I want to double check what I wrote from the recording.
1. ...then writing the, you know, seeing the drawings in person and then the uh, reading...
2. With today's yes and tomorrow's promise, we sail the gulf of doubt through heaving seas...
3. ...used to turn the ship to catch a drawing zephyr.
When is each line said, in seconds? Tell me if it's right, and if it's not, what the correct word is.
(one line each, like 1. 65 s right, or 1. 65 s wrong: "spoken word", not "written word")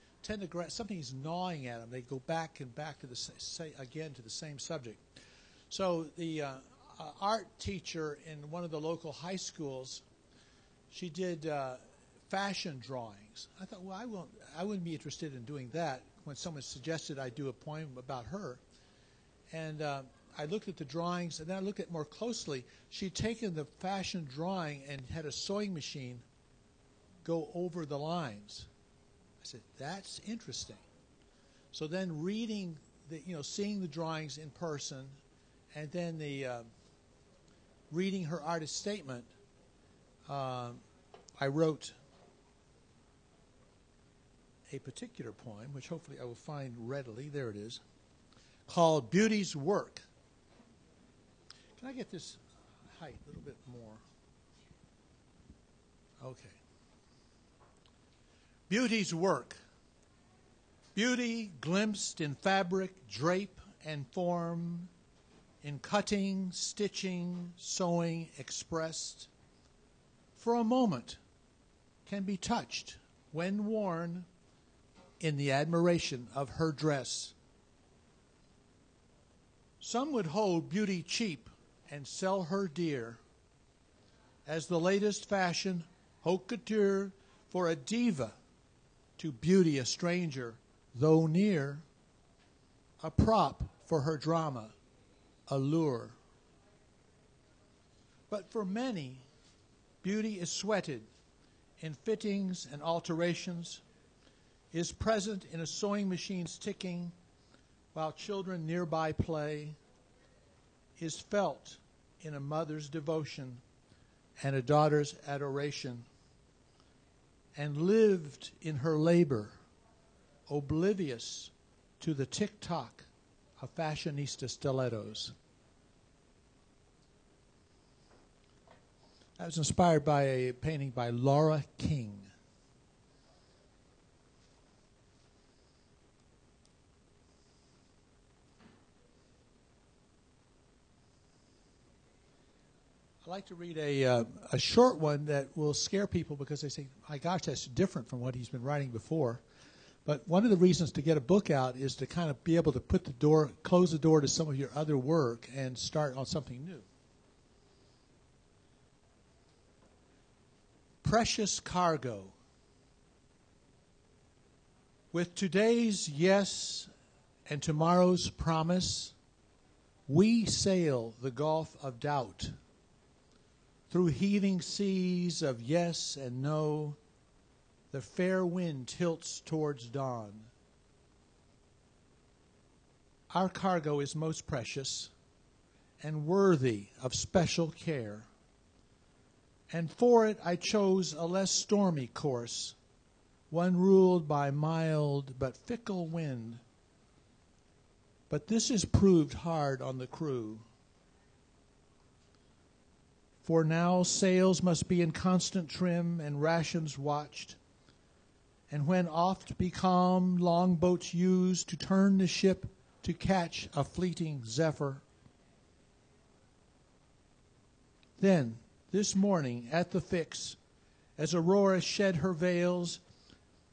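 1. 31 s wrong: "reading", not "writing"
2. 165 s right
3. 211 s wrong: "fleeting", not "drawing".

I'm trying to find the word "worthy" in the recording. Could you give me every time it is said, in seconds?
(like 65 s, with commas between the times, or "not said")
186 s.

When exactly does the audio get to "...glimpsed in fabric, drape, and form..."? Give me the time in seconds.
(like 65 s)
61 s.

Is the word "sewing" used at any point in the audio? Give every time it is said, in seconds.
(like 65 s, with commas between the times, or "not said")
25 s, 67 s, 105 s.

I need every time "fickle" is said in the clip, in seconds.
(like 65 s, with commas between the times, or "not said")
195 s.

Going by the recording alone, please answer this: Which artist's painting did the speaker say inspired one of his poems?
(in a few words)
Laura King.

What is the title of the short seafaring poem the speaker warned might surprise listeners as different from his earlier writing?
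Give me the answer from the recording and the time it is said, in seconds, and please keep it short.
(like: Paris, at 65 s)
Precious Cargo, at 161 s.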